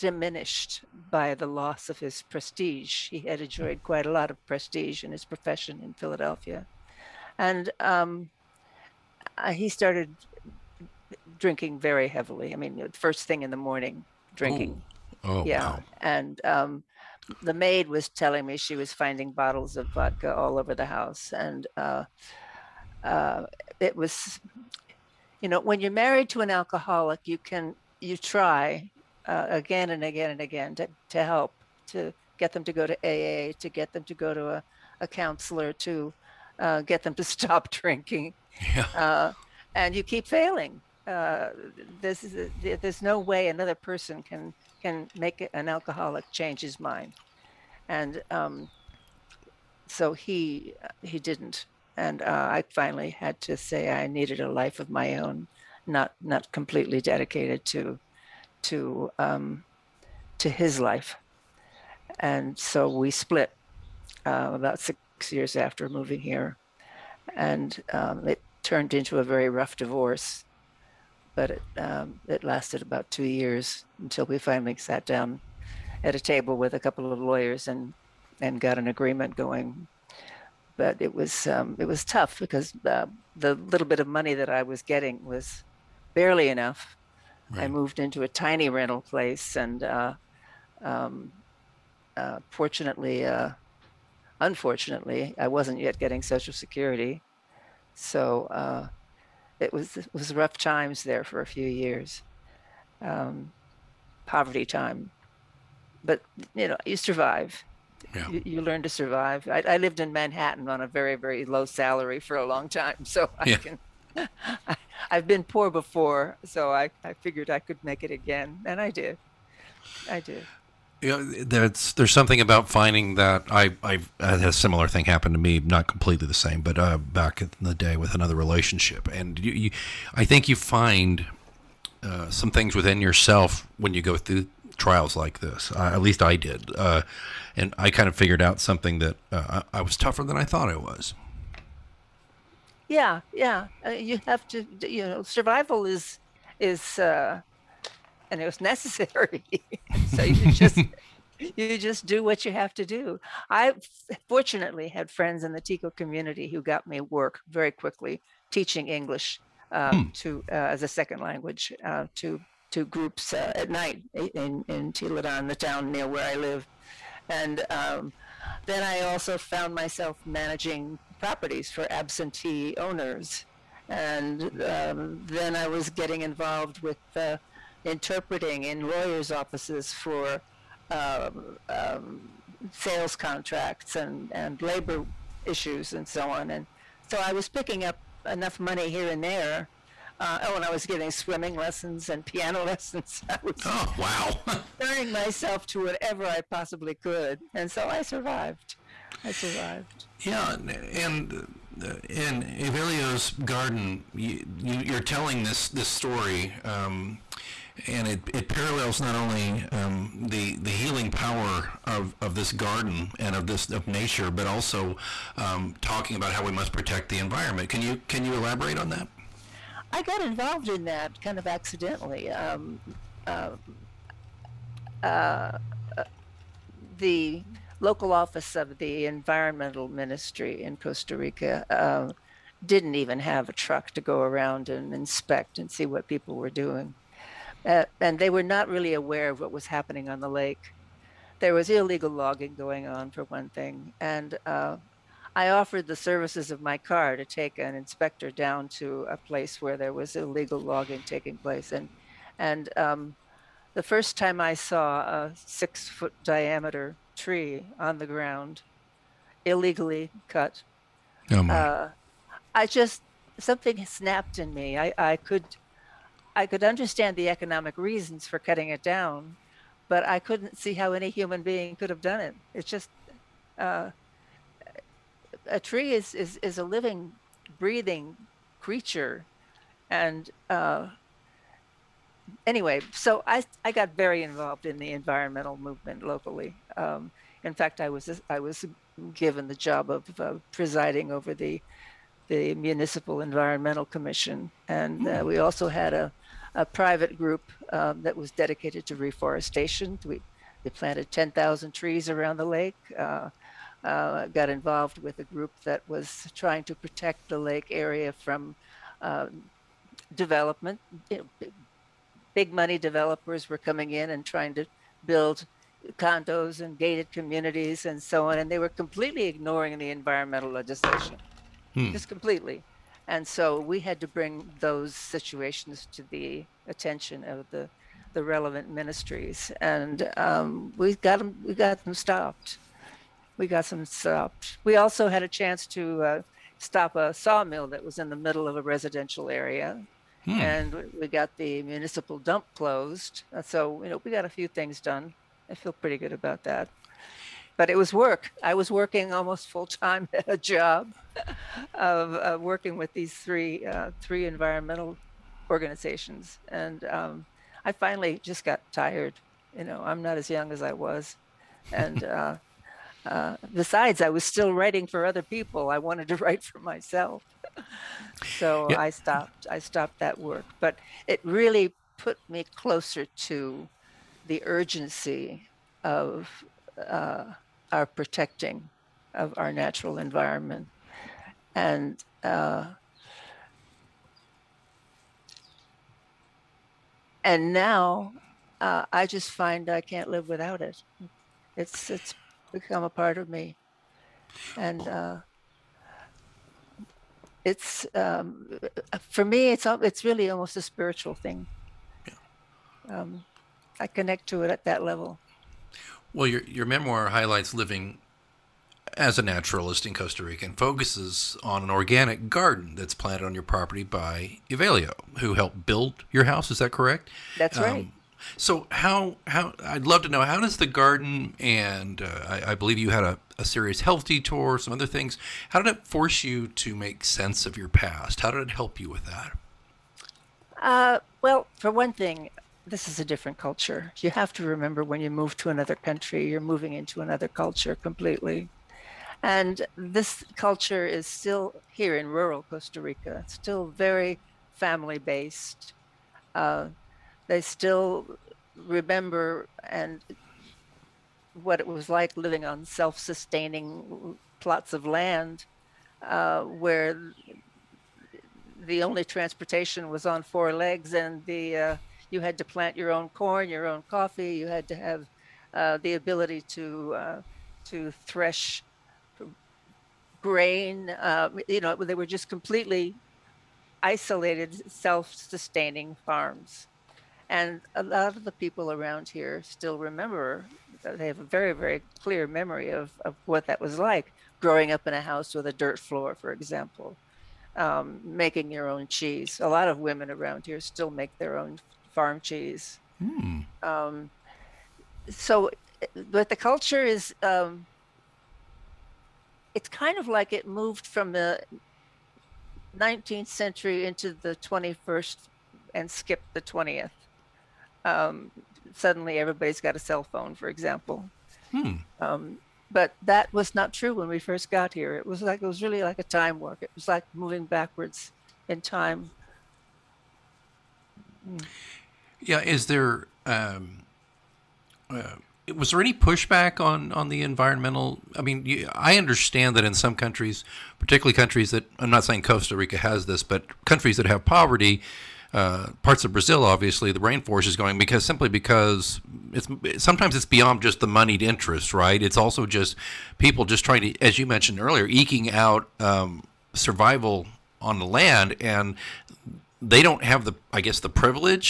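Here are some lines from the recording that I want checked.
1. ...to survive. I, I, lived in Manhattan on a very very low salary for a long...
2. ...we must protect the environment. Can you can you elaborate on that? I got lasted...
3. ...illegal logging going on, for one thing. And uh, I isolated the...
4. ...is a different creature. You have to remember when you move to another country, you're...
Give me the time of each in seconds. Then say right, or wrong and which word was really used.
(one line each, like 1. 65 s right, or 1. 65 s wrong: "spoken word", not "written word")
1. 108 s right
2. 216 s wrong: "involved", not "lasted"
3. 241 s wrong: "offered", not "isolated"
4. 432 s wrong: "culture", not "creature".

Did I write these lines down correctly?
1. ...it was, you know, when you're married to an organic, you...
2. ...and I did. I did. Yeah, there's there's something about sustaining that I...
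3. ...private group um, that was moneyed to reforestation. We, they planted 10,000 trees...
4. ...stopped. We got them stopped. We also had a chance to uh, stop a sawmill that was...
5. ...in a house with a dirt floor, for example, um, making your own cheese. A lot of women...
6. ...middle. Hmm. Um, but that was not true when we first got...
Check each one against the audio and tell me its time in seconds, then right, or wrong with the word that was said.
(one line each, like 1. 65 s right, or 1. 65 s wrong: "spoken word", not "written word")
1. 23 s wrong: "alcoholic", not "organic"
2. 118 s wrong: "finding", not "sustaining"
3. 296 s wrong: "dedicated", not "moneyed"
4. 331 s right
5. 484 s right
6. 510 s wrong: "example", not "middle".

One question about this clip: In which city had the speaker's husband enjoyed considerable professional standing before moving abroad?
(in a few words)
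Philadelphia.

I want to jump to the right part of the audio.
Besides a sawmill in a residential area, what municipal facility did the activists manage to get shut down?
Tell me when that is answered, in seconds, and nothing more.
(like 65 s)
341 s.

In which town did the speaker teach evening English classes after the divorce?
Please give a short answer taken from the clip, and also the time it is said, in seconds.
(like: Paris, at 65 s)
Tilarán, at 164 s.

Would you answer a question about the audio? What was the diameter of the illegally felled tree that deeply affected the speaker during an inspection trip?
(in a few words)
6 feet.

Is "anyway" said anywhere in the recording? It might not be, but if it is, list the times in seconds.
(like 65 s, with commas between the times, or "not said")
282 s.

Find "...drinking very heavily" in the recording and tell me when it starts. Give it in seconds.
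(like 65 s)
11 s.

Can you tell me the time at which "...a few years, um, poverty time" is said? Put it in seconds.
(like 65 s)
101 s.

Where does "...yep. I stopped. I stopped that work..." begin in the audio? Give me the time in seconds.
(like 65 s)
368 s.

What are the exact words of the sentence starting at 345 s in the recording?
I feel pretty good about that but it was work.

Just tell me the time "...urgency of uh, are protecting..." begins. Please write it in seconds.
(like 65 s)
374 s.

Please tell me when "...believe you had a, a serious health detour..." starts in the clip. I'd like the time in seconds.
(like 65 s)
422 s.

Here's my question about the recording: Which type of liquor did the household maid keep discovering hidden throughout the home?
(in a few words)
vodka.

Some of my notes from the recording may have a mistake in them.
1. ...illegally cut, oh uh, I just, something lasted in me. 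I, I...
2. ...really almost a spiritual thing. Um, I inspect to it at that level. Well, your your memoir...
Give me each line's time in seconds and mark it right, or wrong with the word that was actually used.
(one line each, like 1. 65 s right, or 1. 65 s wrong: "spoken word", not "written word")
1. 259 s wrong: "snapped", not "lasted"
2. 400 s wrong: "connect", not "inspect".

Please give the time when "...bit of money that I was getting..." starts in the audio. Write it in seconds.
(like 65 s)
83 s.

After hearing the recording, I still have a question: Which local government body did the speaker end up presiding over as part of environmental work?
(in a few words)
Municipal Environmental Commission.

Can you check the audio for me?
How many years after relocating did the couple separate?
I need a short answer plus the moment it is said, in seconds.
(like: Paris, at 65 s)
6, at 64 s.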